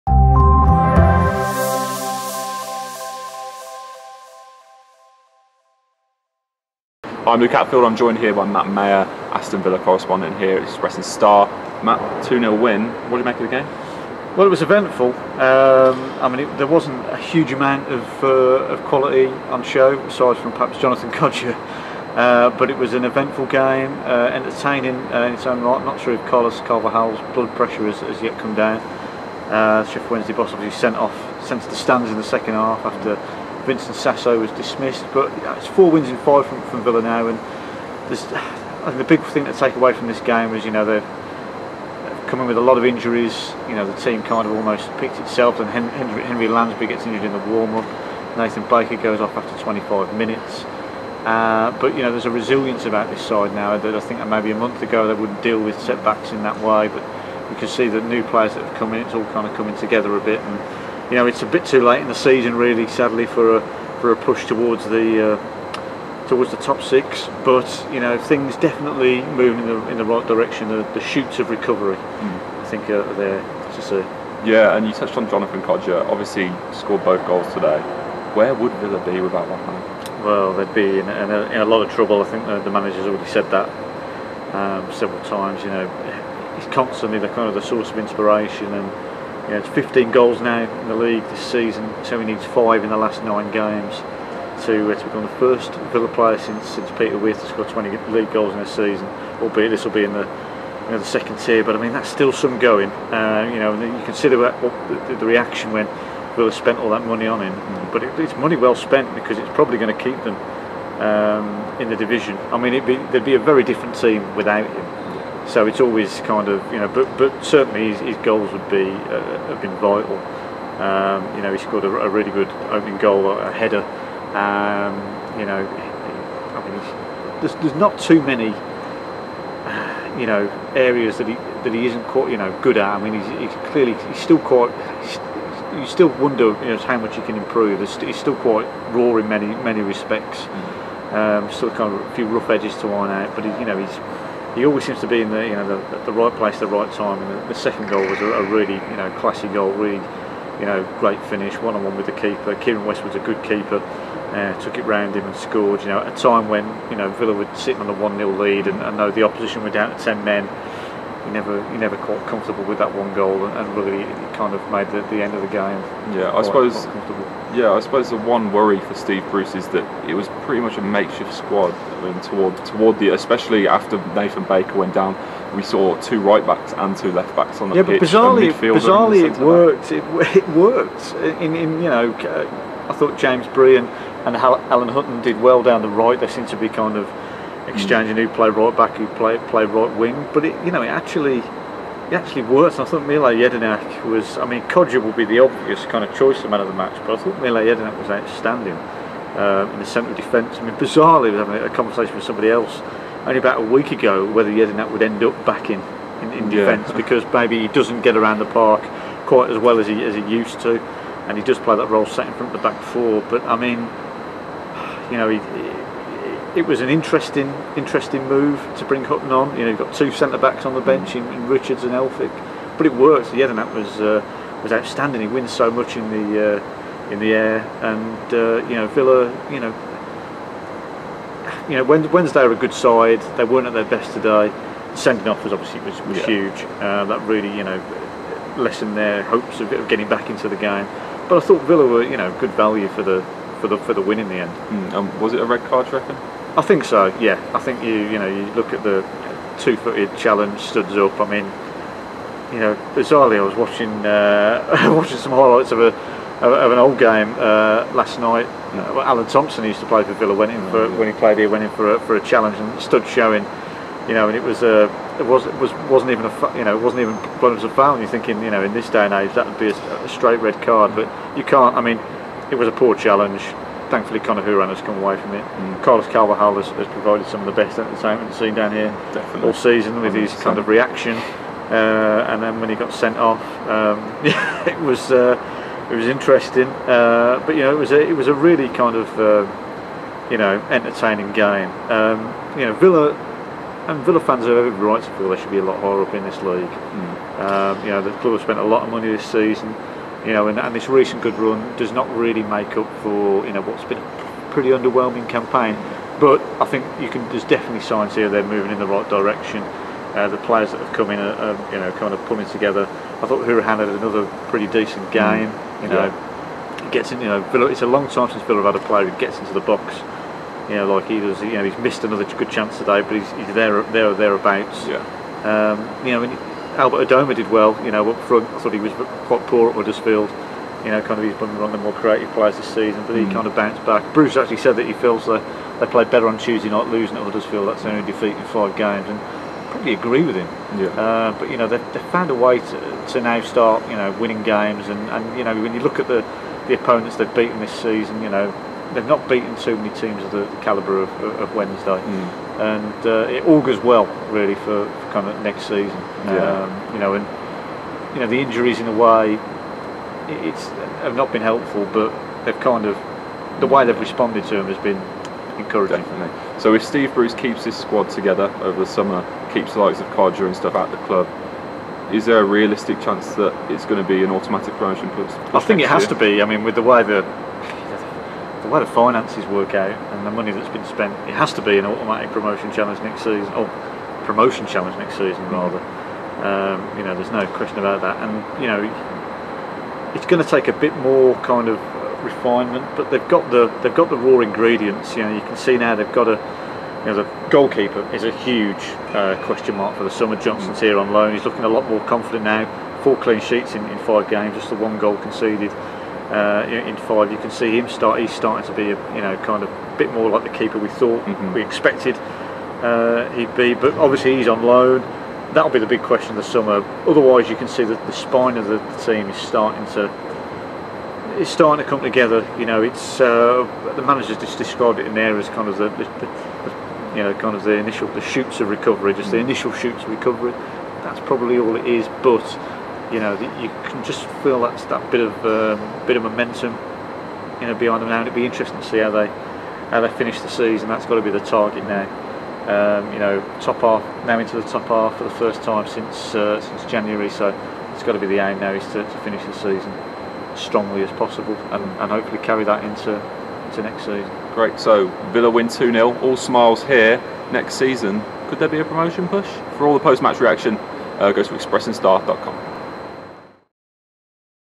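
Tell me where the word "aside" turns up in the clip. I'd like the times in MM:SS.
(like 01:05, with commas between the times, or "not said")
00:20.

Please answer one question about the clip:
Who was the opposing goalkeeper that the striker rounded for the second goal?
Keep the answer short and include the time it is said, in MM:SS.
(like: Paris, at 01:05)
Kieran Westwood, at 02:32.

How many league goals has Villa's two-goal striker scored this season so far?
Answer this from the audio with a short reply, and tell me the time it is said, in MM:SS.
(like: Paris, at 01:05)
15, at 01:29.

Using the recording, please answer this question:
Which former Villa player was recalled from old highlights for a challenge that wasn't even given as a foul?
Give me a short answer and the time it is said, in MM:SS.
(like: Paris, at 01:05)
Alan Thompson, at 04:19.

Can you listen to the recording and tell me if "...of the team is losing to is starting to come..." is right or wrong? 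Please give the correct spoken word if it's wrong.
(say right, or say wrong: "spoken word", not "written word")
wrong: "starting", not "losing".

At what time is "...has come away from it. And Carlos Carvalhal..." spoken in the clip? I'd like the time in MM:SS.
04:34.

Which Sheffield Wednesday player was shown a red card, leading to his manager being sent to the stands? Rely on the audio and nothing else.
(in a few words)
Vincent Sasso.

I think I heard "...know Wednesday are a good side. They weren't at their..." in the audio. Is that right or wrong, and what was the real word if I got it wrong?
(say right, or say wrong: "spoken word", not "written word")
right.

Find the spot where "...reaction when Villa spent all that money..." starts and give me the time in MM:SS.
01:45.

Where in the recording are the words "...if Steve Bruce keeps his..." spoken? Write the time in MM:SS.
06:06.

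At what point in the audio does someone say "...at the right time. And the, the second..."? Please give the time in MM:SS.
02:26.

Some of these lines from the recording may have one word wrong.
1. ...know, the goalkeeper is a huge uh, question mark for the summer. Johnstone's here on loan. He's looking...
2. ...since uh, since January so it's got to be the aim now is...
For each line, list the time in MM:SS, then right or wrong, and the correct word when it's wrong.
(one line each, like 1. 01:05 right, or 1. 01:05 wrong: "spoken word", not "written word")
1. 06:37 right
2. 07:25 right.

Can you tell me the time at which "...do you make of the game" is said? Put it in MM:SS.
00:13.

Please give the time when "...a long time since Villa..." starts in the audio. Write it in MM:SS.
05:17.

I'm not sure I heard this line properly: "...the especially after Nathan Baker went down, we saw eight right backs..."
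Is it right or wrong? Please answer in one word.
wrong.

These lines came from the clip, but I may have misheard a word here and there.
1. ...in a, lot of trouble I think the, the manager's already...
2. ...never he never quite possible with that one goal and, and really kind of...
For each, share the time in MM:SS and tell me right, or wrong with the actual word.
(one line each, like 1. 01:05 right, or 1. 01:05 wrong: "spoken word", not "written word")
1. 01:21 right
2. 02:41 wrong: "comfortable", not "possible".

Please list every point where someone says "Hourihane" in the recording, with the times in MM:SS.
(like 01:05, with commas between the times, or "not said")
04:34, 05:13.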